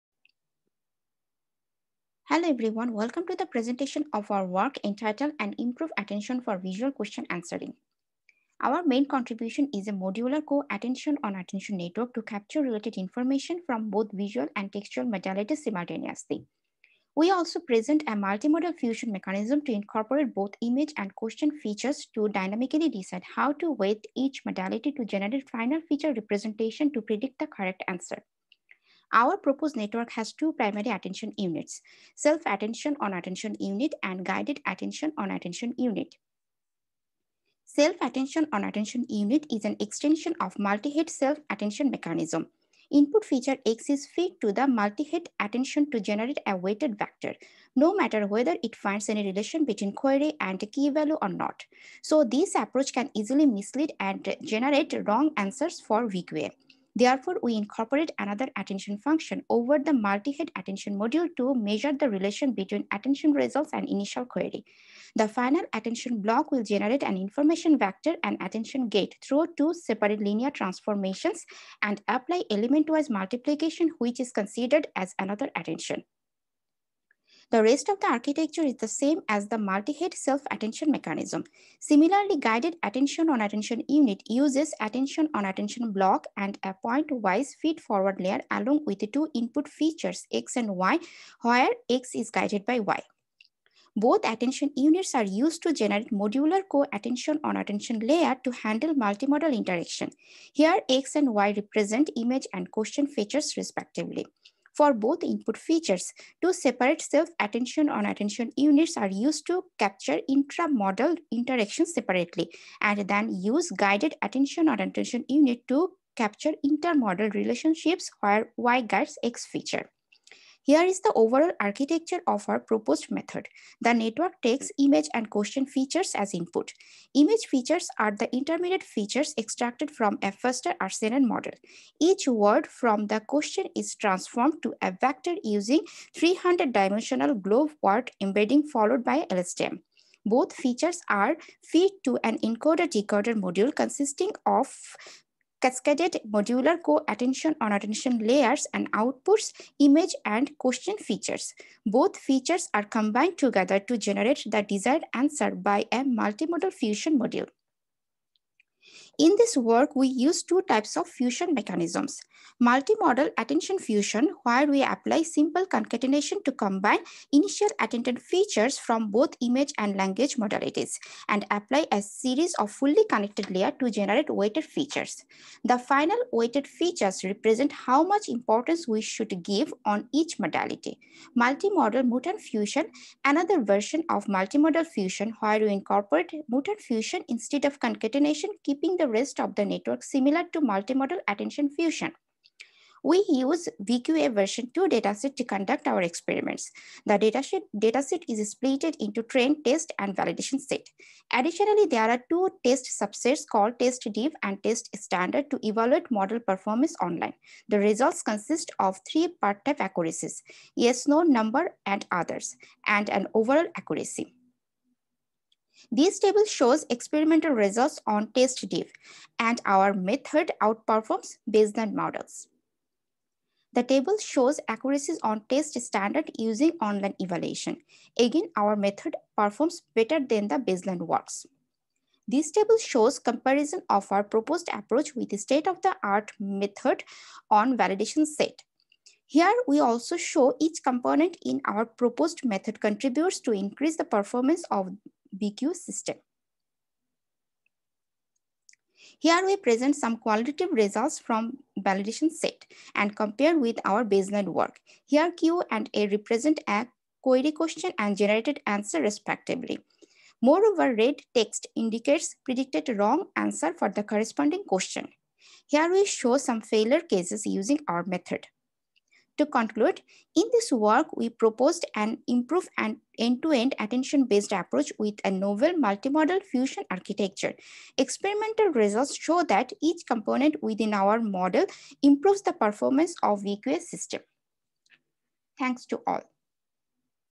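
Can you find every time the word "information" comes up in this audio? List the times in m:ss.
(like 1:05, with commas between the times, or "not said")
0:12, 1:07.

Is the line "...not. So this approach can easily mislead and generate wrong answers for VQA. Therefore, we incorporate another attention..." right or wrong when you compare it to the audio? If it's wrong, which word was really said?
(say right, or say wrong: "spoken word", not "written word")
right.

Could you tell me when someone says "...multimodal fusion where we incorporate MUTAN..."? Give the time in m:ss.
3:04.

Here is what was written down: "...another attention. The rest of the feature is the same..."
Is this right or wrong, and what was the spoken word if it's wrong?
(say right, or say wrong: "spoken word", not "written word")
wrong: "architecture", not "feature".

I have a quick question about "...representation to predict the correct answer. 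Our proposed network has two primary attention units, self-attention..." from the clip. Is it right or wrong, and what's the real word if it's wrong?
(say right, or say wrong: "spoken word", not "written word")
right.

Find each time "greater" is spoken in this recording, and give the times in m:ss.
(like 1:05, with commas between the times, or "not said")
not said.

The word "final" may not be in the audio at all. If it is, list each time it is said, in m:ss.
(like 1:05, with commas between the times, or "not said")
0:25, 1:05, 2:55.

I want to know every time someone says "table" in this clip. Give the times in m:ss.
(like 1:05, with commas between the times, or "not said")
3:36, 3:43, 3:52.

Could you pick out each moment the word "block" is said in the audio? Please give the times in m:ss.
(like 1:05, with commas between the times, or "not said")
1:06, 1:25.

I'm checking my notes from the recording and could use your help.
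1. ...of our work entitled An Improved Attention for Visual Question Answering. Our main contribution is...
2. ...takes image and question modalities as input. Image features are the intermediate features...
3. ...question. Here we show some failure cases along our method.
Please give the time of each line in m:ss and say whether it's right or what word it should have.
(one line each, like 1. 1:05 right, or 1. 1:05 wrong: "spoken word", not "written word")
1. 0:04 right
2. 2:04 wrong: "features", not "modalities"
3. 4:24 wrong: "using", not "along".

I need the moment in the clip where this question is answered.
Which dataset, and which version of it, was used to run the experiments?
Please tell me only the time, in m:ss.
3:13.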